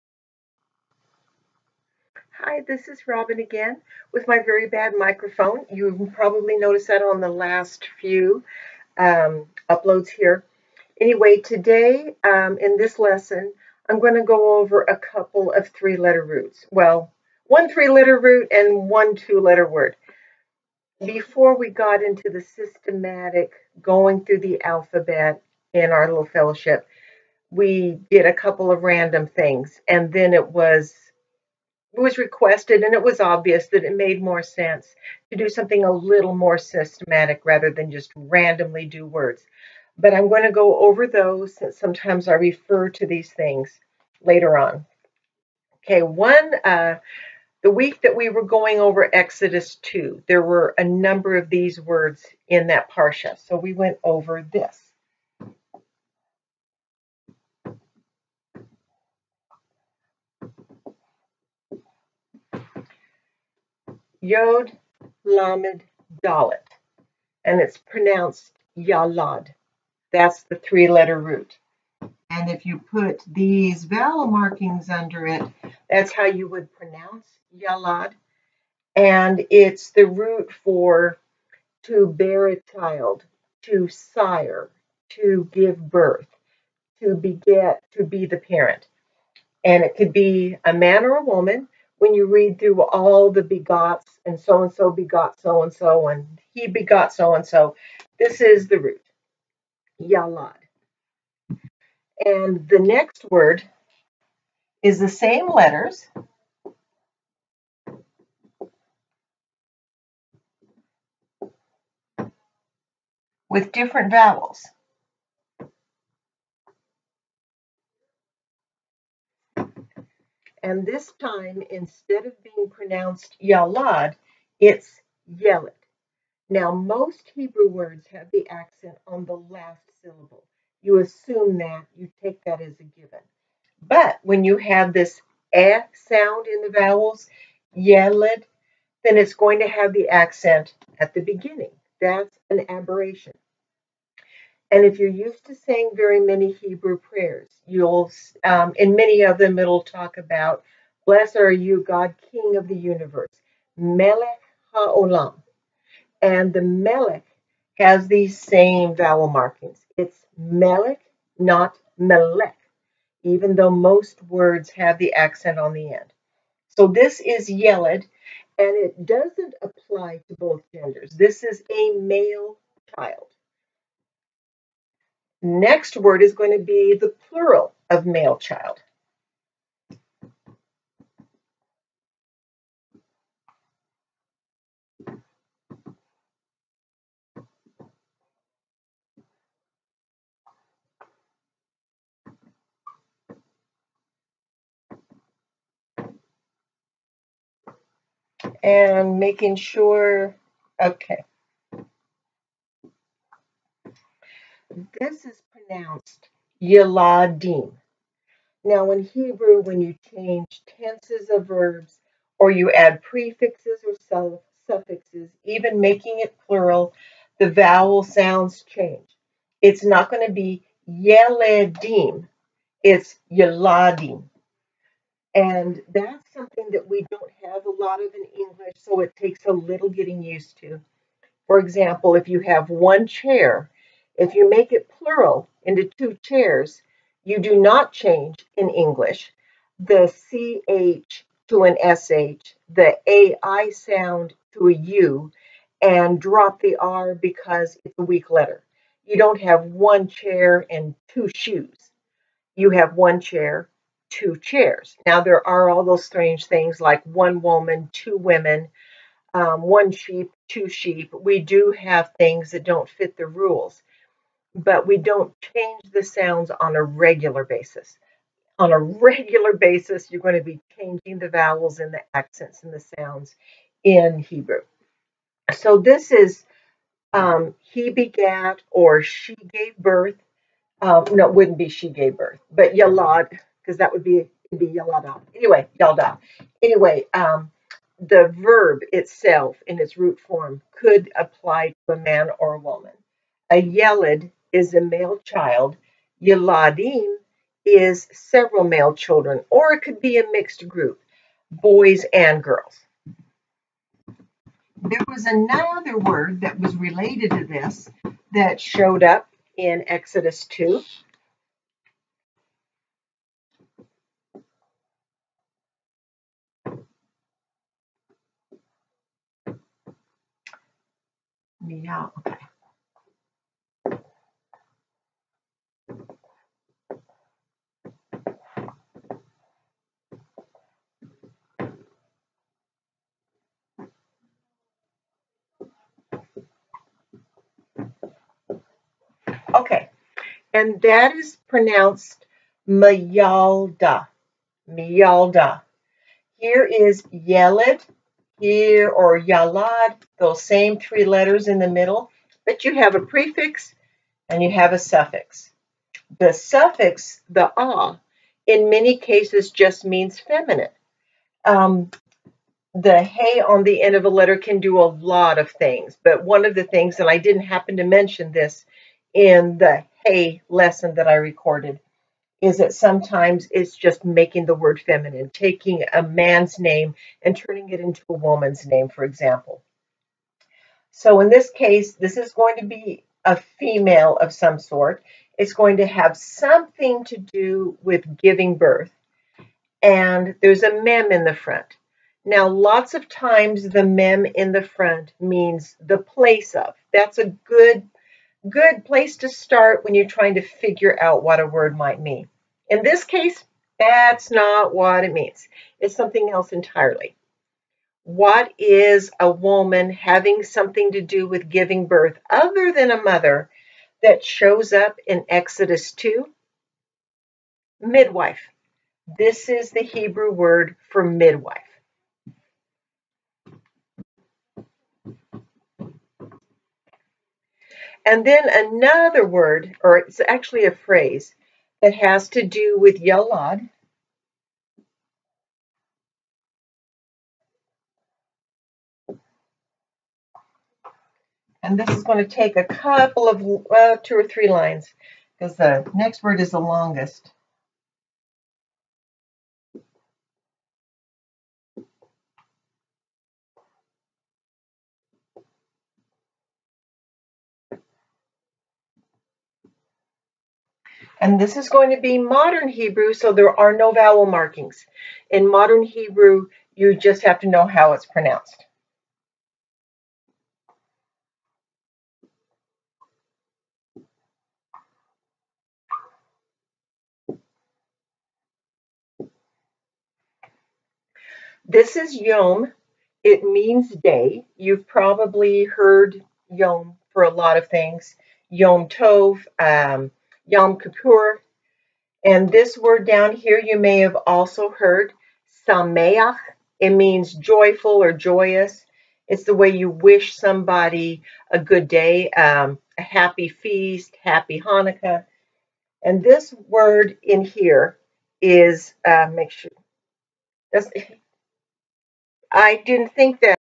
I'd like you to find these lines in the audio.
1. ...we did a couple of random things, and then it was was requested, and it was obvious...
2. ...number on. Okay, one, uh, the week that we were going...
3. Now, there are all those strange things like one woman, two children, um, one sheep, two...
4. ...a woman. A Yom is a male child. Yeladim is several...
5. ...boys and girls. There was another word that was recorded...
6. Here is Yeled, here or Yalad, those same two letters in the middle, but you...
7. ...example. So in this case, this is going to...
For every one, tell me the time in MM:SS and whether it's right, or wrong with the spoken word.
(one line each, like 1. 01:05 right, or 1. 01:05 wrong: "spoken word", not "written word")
1. 00:27 right
2. 00:44 wrong: "later", not "number"
3. 04:15 wrong: "women", not "children"
4. 04:52 wrong: "Yeled", not "Yom"
5. 05:01 wrong: "related", not "recorded"
6. 05:46 wrong: "three", not "two"
7. 06:19 right.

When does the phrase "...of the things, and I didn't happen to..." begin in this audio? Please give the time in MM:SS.
06:06.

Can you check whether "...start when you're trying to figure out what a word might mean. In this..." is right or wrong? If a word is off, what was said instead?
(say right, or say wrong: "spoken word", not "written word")
right.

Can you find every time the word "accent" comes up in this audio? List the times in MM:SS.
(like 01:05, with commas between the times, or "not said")
02:08, 02:20, 02:45, 04:32.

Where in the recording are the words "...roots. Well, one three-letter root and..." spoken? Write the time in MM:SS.
00:16.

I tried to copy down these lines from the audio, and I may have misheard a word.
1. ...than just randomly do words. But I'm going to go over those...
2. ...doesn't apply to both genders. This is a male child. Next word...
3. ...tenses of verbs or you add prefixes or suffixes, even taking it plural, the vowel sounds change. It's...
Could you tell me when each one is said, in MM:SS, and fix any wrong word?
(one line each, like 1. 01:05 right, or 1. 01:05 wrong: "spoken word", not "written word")
1. 00:37 right
2. 02:49 right
3. 03:30 wrong: "making", not "taking".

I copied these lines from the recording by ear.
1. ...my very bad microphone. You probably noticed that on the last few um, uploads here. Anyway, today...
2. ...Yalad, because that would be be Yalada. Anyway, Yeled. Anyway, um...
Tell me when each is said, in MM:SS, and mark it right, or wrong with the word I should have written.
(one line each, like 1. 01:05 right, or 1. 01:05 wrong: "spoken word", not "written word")
1. 00:04 right
2. 04:42 wrong: "Yalda", not "Yeled".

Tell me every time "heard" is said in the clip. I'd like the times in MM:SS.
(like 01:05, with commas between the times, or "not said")
08:05, 08:14.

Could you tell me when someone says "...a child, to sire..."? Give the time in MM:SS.
01:22.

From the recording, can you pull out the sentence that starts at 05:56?
The suffix, the ah, in many cases just means feminine.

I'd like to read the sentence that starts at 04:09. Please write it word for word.
You don't have one chair and two shoes.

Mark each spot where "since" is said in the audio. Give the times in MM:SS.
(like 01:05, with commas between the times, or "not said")
00:41.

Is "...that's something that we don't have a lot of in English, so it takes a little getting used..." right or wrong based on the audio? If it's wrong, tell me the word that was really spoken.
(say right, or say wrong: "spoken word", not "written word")
right.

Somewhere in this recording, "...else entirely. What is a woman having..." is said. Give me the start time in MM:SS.
06:46.